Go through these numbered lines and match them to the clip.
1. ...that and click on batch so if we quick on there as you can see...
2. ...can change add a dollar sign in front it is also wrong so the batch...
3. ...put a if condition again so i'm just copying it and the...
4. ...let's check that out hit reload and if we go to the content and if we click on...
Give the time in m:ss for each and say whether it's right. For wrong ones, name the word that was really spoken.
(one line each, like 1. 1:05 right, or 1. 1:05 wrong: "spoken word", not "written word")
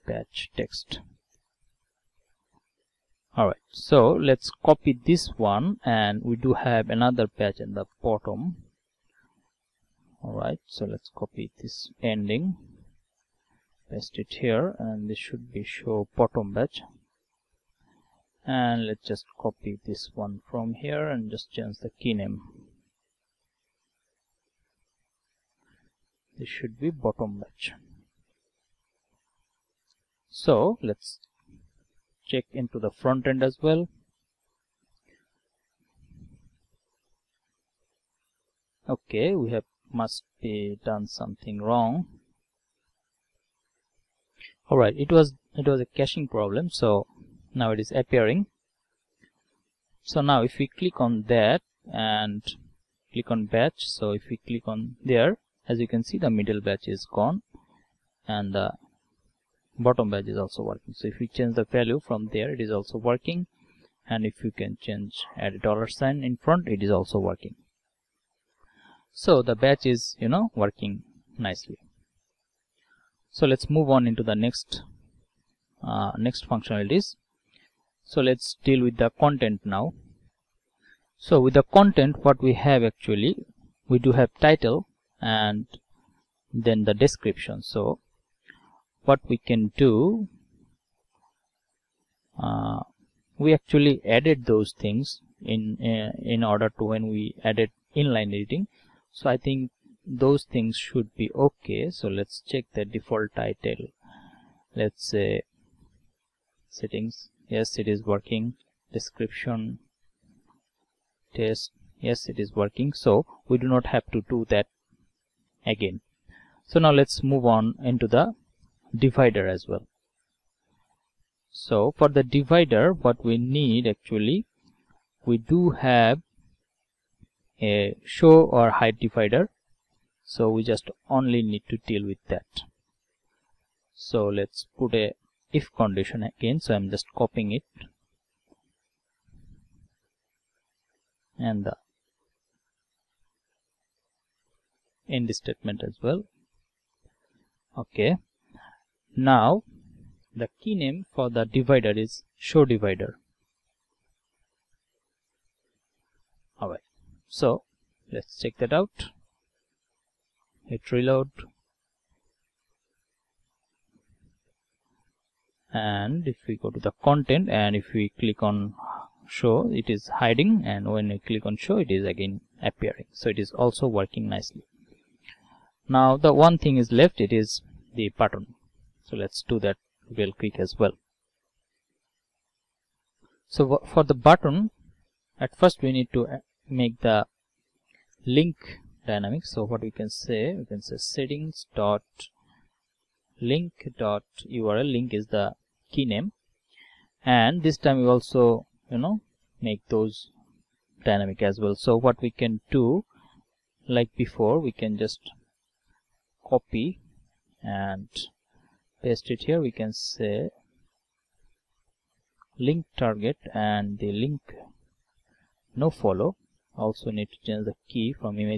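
1. 0:51 wrong: "click", not "quick"
2. 1:04 wrong: "working", not "wrong"
3. 2:14 right
4. 2:38 right.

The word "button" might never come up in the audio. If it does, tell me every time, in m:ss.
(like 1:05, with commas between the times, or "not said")
2:58, 3:04.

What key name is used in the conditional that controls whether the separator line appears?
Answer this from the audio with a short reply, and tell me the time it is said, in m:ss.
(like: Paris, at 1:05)
show divider, at 2:32.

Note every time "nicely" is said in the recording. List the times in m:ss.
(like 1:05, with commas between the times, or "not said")
1:11, 2:54.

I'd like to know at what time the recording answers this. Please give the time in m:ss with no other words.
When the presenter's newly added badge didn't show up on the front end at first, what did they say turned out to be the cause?
0:45.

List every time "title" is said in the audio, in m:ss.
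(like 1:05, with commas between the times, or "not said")
1:24, 1:43.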